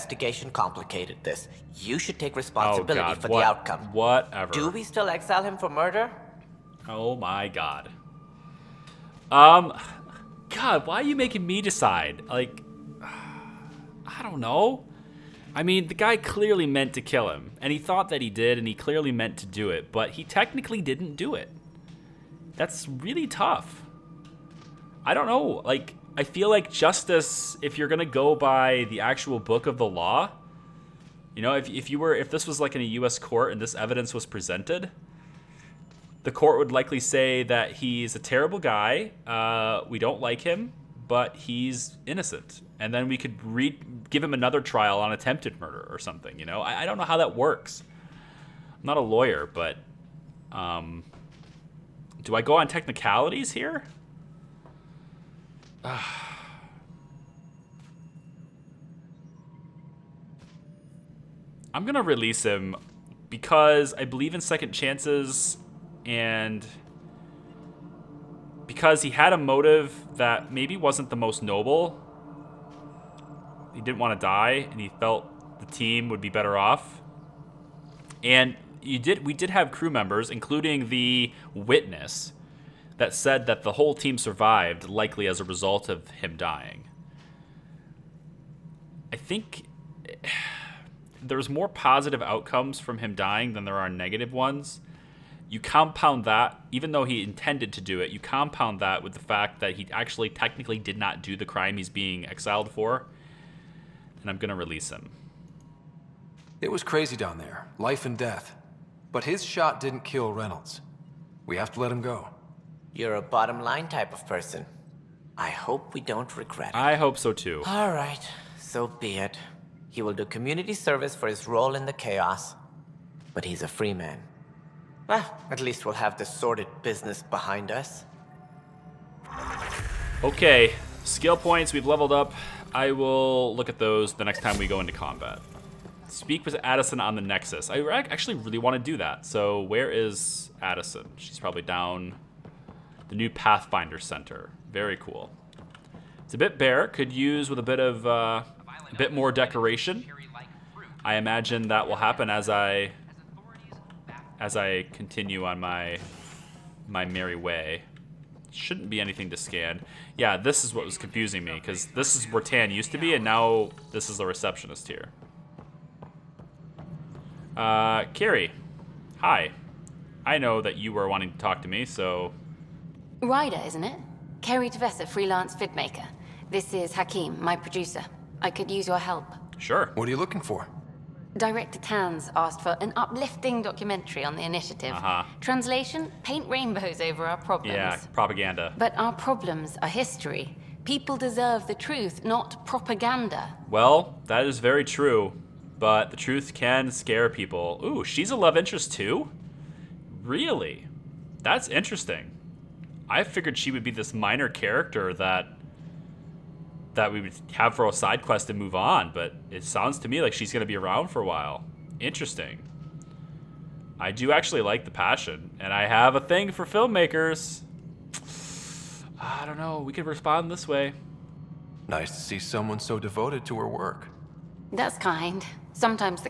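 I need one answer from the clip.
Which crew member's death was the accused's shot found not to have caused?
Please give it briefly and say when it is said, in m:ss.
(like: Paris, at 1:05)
Reynolds, at 1:50.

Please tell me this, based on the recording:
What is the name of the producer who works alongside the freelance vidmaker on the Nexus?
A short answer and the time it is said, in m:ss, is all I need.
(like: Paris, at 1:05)
Hakim, at 2:56.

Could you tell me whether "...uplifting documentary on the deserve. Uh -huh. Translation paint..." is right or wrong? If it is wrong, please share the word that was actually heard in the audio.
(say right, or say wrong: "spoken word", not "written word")
wrong: "initiative", not "deserve".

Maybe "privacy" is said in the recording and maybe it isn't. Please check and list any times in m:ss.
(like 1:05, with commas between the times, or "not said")
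not said.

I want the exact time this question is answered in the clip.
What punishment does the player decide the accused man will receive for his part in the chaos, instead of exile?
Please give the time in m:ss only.
2:00.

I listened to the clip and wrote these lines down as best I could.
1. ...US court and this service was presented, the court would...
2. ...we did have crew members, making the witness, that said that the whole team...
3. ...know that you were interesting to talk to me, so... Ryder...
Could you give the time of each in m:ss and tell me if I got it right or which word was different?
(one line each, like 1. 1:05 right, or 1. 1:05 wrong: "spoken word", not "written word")
1. 0:32 wrong: "evidence", not "service"
2. 1:19 wrong: "including", not "making"
3. 2:50 wrong: "wanting", not "interesting".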